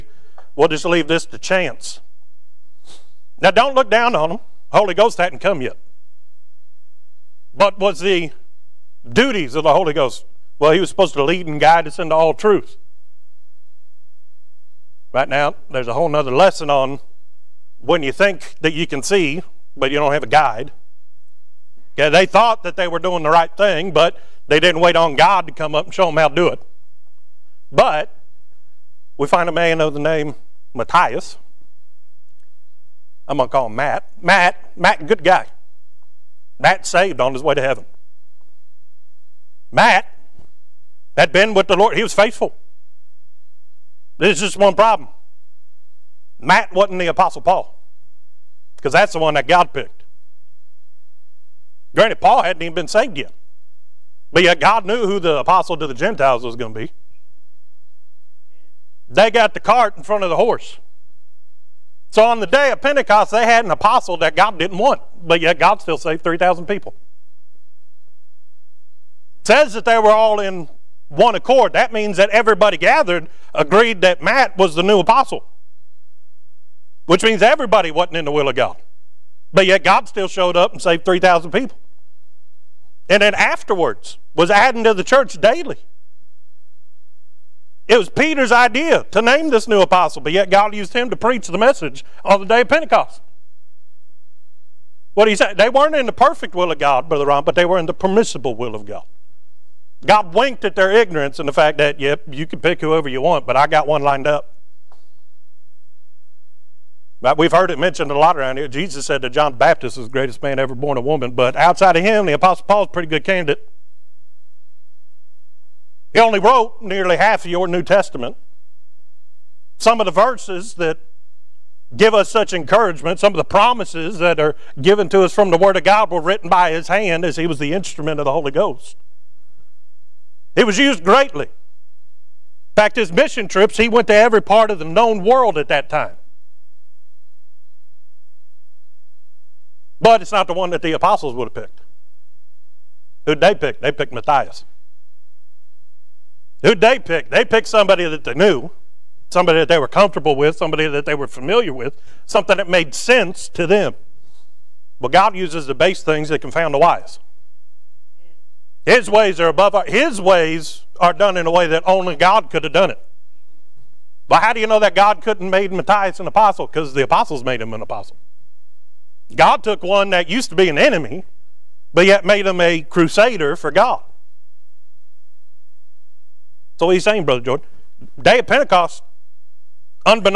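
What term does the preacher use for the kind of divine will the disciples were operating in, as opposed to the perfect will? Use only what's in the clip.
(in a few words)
permissible will.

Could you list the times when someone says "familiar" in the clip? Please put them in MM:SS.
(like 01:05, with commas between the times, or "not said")
02:31.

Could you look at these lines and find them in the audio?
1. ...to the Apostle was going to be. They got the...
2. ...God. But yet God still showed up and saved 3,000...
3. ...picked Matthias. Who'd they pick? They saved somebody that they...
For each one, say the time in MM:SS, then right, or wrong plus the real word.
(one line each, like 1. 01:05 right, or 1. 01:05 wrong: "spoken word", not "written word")
1. 00:55 wrong: "Gentiles", not "Apostle"
2. 01:18 right
3. 02:23 wrong: "picked", not "saved".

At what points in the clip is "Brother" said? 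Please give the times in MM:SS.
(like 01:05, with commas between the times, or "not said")
01:37, 02:57.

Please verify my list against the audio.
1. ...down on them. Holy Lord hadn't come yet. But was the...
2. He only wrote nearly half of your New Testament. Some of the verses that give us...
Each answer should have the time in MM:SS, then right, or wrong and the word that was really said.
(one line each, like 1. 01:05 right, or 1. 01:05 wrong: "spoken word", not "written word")
1. 00:03 wrong: "Ghost", not "Lord"
2. 01:56 right.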